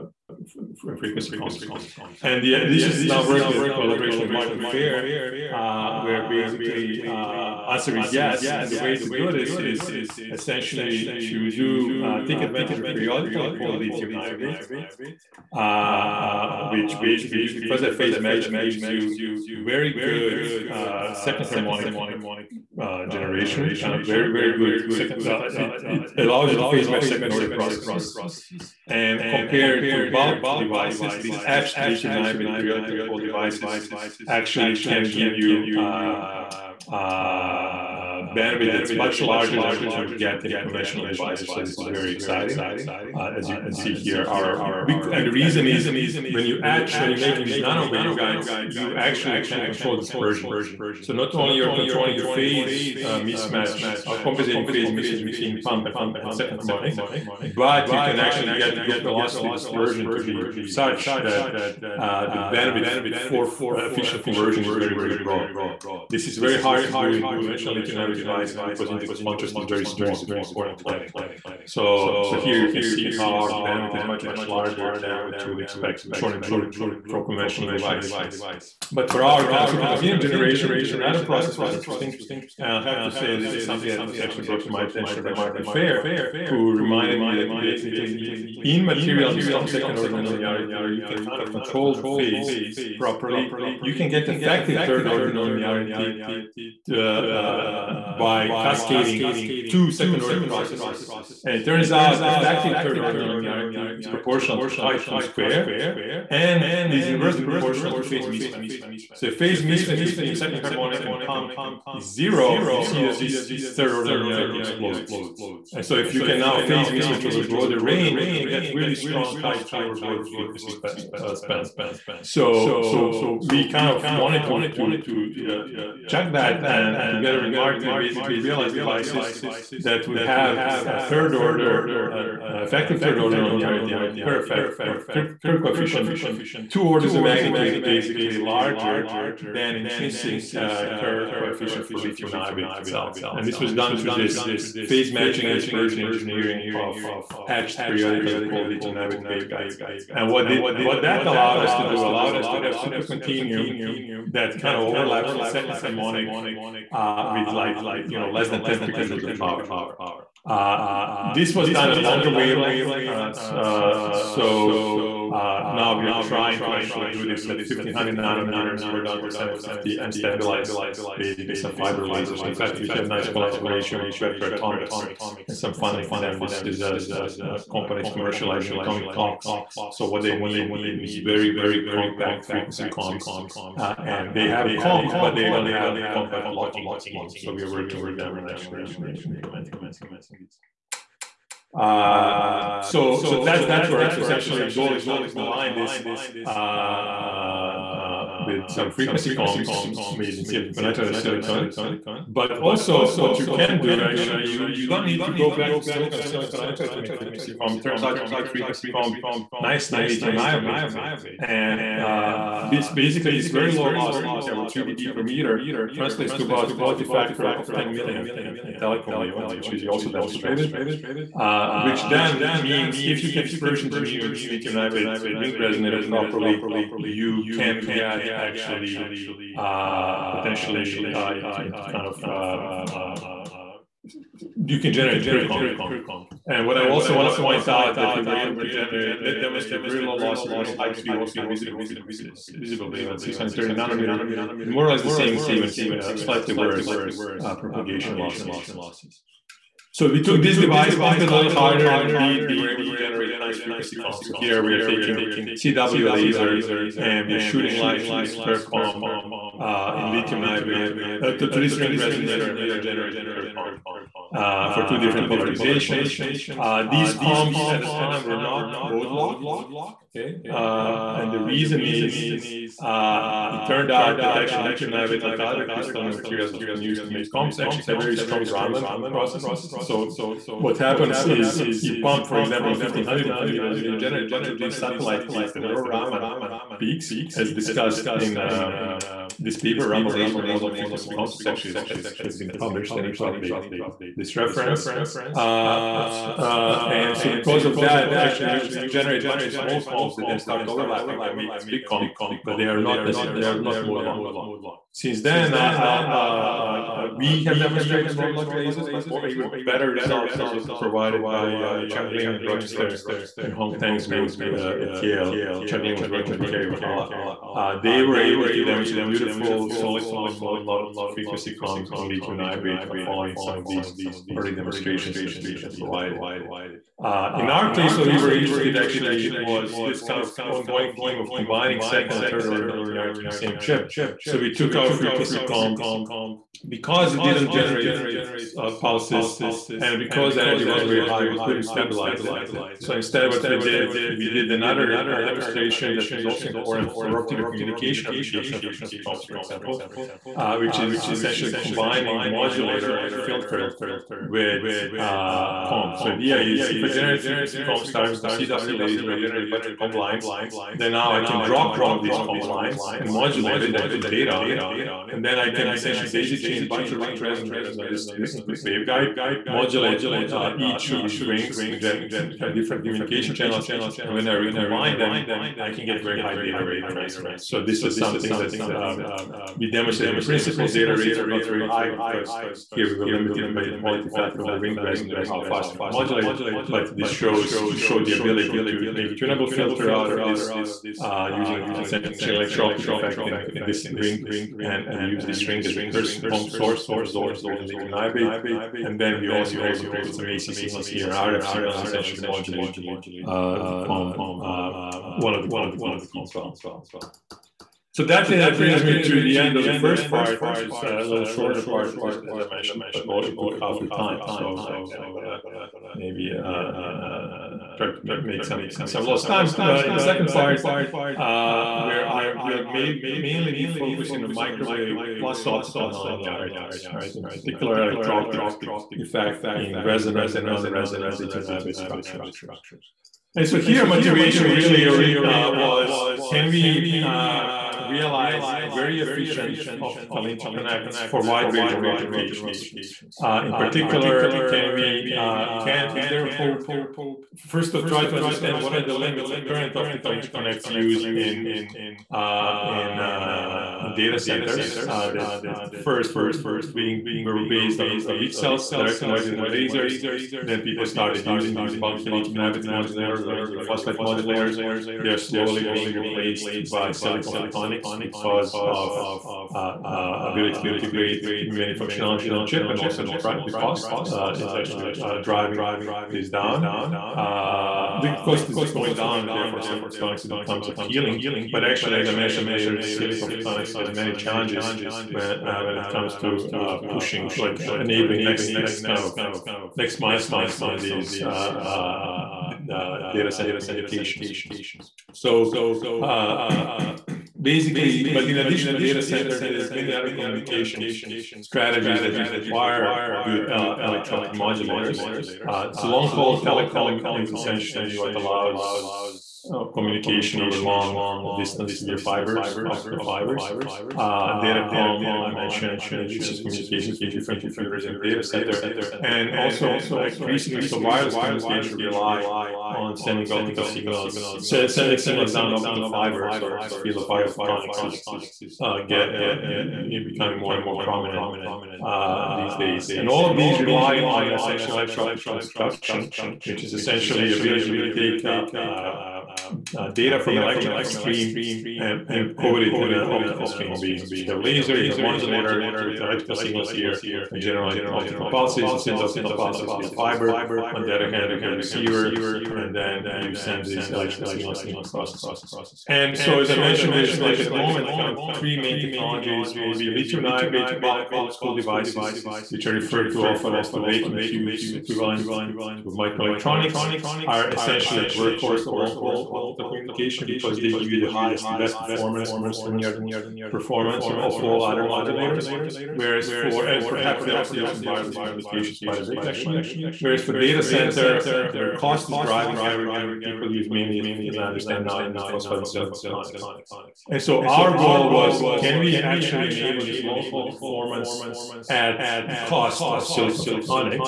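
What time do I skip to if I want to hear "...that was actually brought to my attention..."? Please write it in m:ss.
1:23.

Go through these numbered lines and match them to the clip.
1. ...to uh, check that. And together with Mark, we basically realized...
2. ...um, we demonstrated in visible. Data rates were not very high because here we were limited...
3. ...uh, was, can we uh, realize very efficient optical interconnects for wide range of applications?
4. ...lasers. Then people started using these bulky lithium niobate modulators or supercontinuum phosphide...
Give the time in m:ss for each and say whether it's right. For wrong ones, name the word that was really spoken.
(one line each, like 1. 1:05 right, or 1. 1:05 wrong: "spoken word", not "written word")
1. 2:05 right
2. 6:18 wrong: "principle", not "visible"
3. 7:15 right
4. 7:39 wrong: "indium", not "supercontinuum".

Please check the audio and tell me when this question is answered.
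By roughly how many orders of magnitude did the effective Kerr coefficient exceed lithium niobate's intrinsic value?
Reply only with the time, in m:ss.
2:16.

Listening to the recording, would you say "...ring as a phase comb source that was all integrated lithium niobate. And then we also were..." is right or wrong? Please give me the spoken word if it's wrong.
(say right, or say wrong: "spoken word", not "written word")
wrong: "curse", not "phase".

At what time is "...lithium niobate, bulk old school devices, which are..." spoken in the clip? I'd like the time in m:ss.
9:19.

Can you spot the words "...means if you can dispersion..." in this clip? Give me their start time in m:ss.
3:42.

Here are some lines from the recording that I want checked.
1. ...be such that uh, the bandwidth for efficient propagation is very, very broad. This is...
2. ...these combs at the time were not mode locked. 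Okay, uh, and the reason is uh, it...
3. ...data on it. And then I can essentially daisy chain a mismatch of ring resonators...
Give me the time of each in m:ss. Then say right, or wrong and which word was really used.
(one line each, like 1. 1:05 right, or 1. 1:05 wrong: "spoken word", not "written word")
1. 1:00 wrong: "conversion", not "propagation"
2. 4:26 right
3. 6:04 wrong: "bunch", not "mismatch".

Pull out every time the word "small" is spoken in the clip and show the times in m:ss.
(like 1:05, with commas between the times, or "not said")
1:09, 4:59.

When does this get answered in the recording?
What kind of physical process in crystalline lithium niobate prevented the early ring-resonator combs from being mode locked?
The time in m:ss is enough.
4:38.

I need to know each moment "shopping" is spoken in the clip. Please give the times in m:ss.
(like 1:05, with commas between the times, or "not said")
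not said.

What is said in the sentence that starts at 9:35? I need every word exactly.
Whereas for, and perhaps they're also using wireless communications quite a bit actually.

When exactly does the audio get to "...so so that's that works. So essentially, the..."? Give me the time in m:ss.
3:12.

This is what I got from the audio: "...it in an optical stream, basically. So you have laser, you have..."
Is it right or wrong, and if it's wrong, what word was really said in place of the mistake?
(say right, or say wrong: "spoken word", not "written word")
right.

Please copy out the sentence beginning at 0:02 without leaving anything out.
And the, this is now work with collaboration with Marty Fejer, uh, where basically uh, answer is yes.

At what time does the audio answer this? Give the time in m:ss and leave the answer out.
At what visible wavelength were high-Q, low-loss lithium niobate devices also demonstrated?
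4:03.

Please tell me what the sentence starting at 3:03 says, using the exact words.
Uh, and they have comb, but they don't have compact locking schemes.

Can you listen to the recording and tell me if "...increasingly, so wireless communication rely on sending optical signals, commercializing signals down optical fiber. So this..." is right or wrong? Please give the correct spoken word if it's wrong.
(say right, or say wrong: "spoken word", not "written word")
wrong: "sending", not "commercializing".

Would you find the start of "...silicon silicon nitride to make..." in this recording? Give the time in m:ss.
3:25.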